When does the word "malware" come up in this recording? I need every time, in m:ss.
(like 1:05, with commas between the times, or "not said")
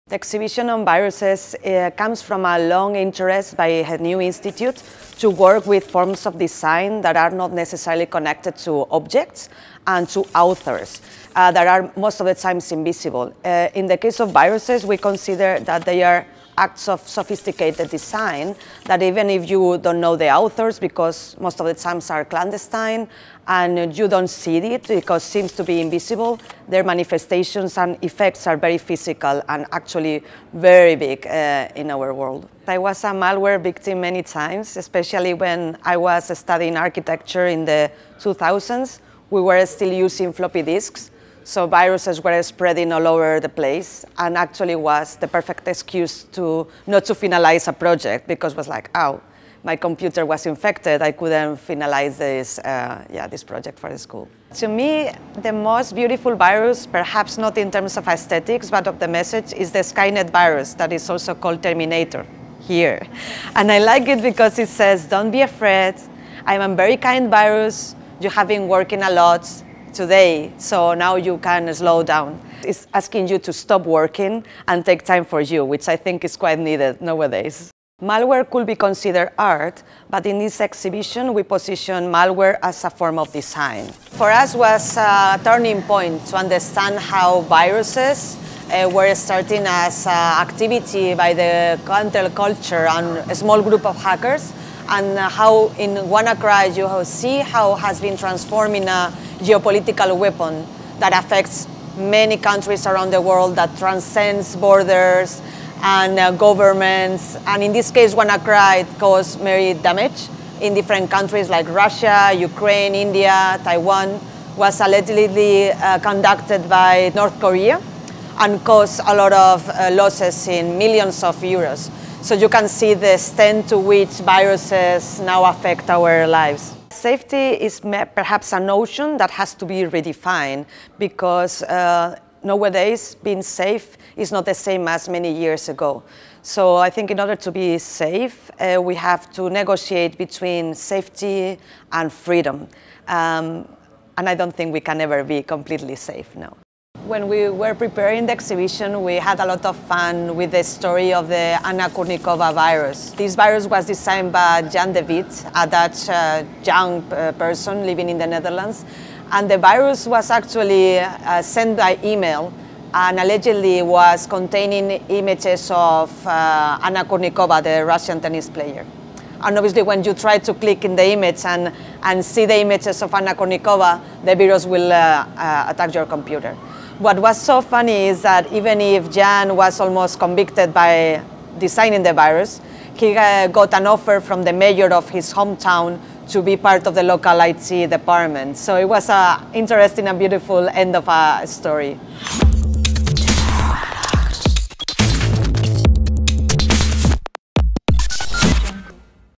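0:33, 1:18, 1:22.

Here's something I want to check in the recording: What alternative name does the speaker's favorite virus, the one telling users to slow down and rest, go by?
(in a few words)
Terminator.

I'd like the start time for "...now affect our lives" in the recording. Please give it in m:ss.
2:05.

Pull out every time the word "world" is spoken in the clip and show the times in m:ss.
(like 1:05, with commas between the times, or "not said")
0:32, 1:43.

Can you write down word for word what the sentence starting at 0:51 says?
I couldn't finalize this, uh, yeah, this project for the school.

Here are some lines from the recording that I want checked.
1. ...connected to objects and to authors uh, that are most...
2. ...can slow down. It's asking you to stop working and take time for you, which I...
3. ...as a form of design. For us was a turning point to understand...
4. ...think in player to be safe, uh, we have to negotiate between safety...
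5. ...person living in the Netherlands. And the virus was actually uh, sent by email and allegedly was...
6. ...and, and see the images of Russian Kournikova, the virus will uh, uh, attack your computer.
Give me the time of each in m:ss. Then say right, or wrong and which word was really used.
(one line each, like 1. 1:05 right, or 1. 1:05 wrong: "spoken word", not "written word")
1. 0:08 right
2. 1:11 right
3. 1:22 right
4. 2:16 wrong: "order", not "player"
5. 2:37 right
6. 2:51 wrong: "Anna", not "Russian".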